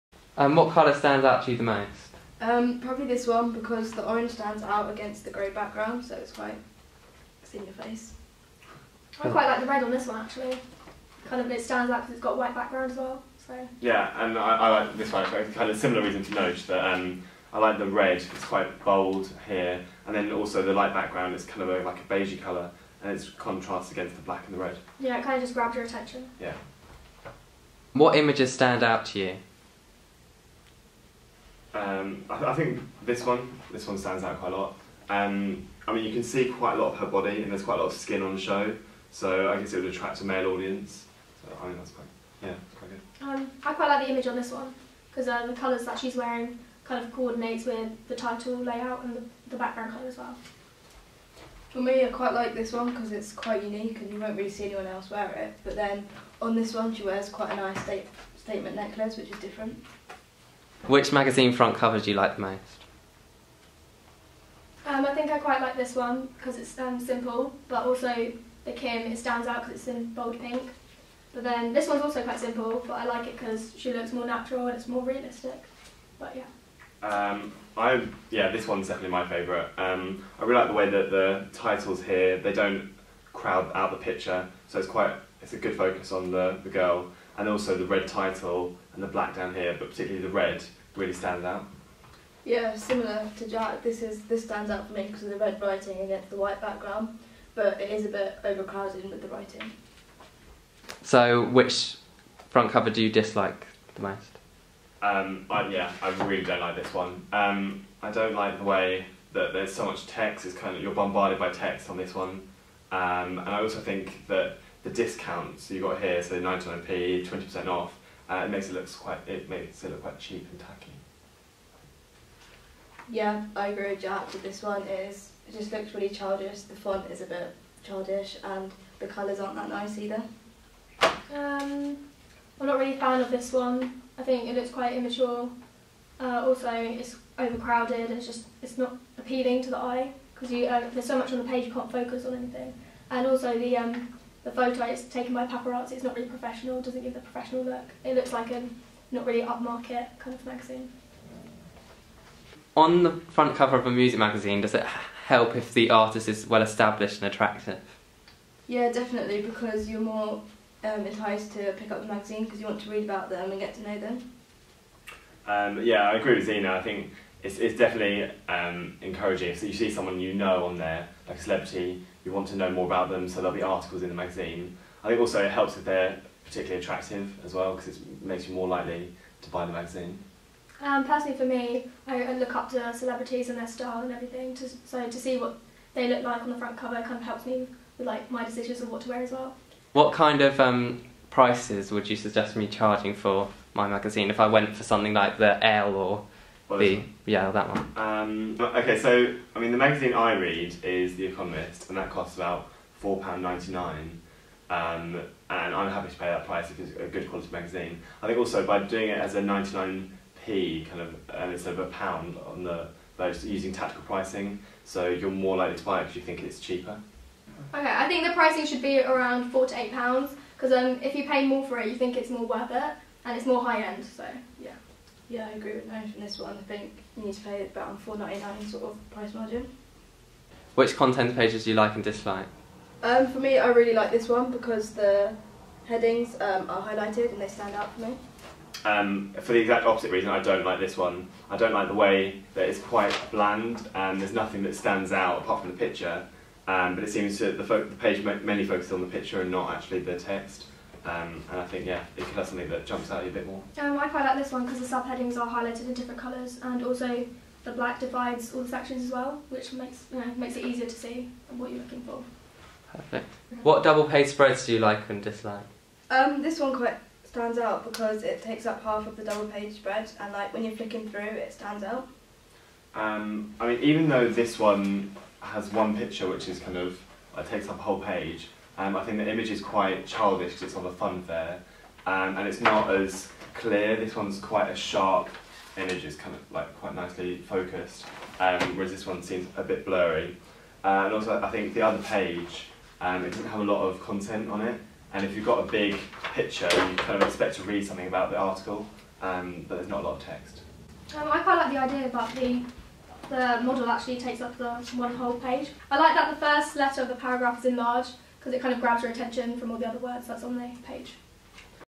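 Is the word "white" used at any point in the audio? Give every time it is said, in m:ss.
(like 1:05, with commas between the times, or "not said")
0:12, 1:36.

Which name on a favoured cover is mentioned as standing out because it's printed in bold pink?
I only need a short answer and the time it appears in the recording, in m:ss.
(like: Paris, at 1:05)
Kim, at 1:08.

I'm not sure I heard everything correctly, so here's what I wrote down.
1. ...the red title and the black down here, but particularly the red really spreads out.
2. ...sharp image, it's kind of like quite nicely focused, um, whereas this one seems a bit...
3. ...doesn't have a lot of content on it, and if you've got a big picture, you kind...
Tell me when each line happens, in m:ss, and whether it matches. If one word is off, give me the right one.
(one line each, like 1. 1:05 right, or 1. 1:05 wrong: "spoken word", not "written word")
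1. 1:27 wrong: "stands", not "spreads"
2. 4:44 right
3. 4:53 right.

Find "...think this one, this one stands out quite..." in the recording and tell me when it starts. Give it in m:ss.
0:32.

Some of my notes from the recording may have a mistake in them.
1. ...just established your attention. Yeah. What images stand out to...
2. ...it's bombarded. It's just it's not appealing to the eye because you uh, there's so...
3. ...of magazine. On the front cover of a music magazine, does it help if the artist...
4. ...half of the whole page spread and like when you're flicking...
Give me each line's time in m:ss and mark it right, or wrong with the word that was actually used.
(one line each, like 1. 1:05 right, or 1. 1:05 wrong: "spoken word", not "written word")
1. 0:25 wrong: "grabbed", not "established"
2. 2:16 wrong: "overcrowded", not "bombarded"
3. 2:30 right
4. 4:28 wrong: "double", not "whole".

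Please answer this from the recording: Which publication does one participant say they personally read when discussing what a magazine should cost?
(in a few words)
The Economist.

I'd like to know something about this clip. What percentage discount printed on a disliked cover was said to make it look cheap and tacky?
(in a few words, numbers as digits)
20%.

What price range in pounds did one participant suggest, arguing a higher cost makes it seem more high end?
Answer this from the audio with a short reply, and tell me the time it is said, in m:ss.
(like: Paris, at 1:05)
£4 to £8, at 3:39.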